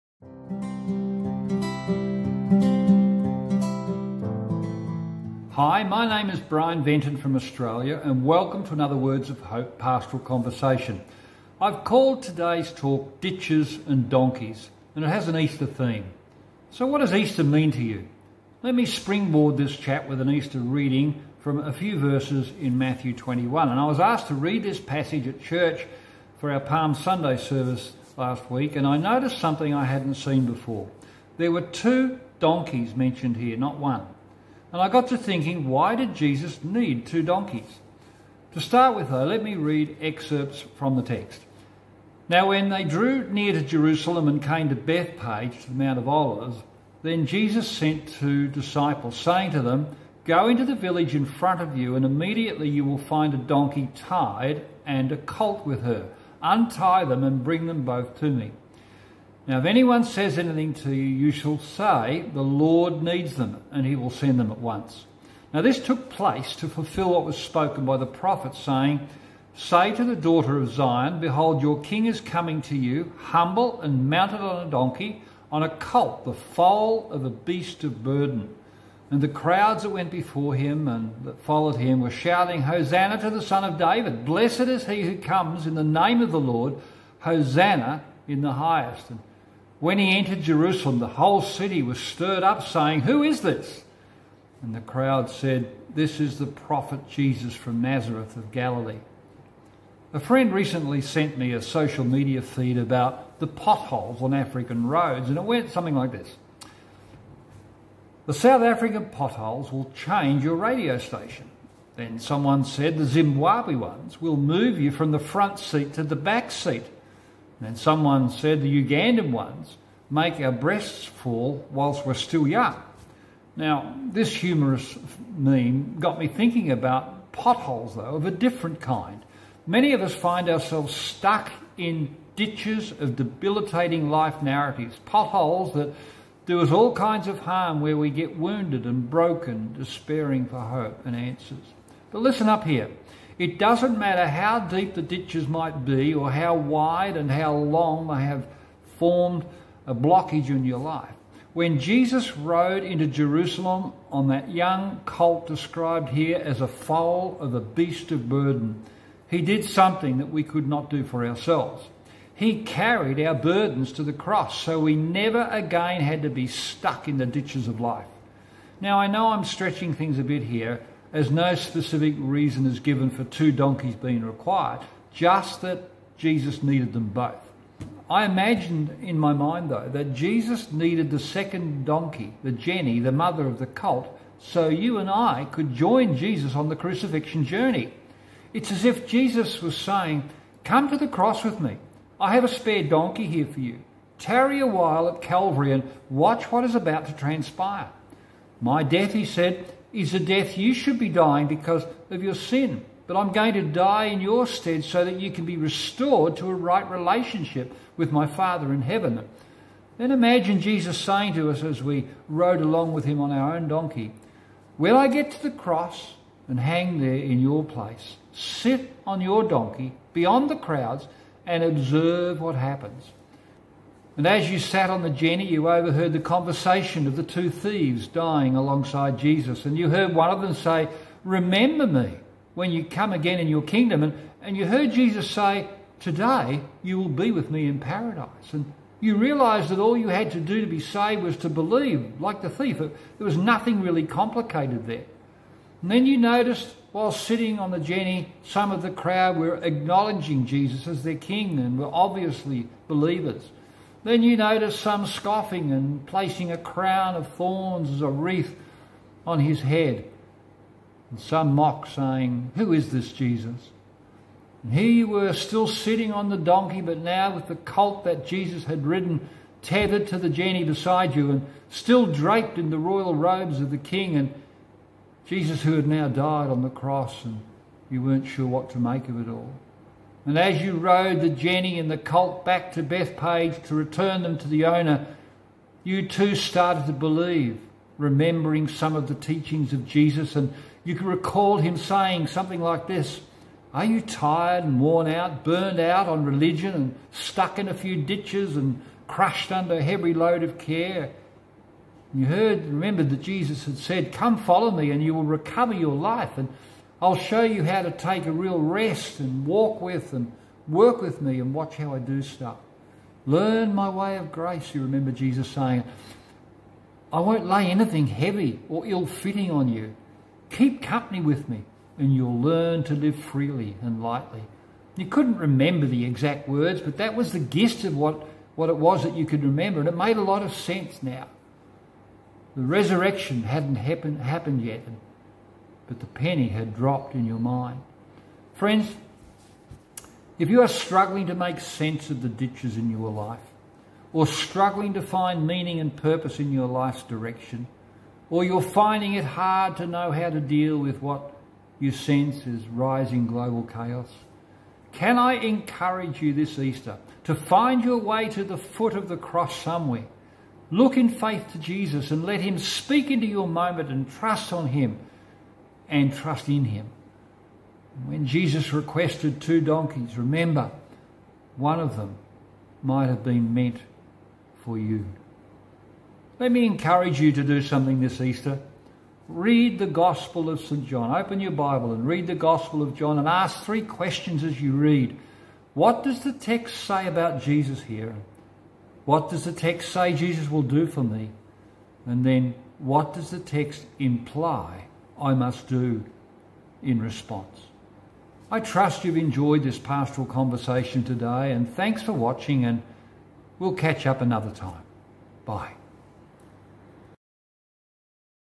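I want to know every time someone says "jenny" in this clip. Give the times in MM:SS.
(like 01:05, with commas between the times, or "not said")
03:02, 03:45, 04:07, 04:30, 04:41.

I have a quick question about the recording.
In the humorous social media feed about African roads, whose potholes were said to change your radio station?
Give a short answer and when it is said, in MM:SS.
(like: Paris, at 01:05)
South African, at 01:48.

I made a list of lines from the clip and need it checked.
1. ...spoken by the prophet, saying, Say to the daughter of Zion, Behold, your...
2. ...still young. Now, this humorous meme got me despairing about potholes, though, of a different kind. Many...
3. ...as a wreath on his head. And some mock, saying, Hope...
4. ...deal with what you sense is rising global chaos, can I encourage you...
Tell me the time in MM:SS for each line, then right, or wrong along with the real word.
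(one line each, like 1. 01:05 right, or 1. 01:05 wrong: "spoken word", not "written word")
1. 01:07 right
2. 02:02 wrong: "thinking", not "despairing"
3. 04:17 wrong: "Who", not "Hope"
4. 05:50 right.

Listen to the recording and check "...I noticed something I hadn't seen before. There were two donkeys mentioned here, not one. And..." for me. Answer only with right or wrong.
right.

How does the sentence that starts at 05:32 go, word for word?
The resurrection hadn't happen, happened yet, but the penny had dropped in your mind.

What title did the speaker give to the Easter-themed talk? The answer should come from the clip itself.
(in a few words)
Ditches and Donkeys.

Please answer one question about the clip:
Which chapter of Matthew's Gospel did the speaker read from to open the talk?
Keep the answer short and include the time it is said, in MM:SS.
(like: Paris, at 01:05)
Matthew 21, at 00:22.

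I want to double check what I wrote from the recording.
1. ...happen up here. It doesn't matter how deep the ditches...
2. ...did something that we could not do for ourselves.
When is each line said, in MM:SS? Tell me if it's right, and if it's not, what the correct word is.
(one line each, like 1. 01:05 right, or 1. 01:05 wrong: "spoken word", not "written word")
1. 02:22 wrong: "listen", not "happen"
2. 02:39 right.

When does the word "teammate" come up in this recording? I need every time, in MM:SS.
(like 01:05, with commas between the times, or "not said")
not said.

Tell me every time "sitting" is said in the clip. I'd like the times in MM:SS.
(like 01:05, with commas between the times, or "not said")
04:07, 04:25.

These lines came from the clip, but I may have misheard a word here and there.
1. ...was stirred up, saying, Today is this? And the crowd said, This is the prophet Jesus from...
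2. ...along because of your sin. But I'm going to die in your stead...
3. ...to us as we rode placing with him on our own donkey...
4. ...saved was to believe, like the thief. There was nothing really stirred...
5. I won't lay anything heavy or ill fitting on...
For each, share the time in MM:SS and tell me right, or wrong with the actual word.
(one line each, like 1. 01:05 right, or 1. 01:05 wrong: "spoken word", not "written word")
1. 01:31 wrong: "Who", not "Today"
2. 03:21 wrong: "dying", not "along"
3. 03:31 wrong: "along", not "placing"
4. 04:00 wrong: "complicated", not "stirred"
5. 05:17 right.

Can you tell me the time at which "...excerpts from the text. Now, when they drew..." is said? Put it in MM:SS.
00:40.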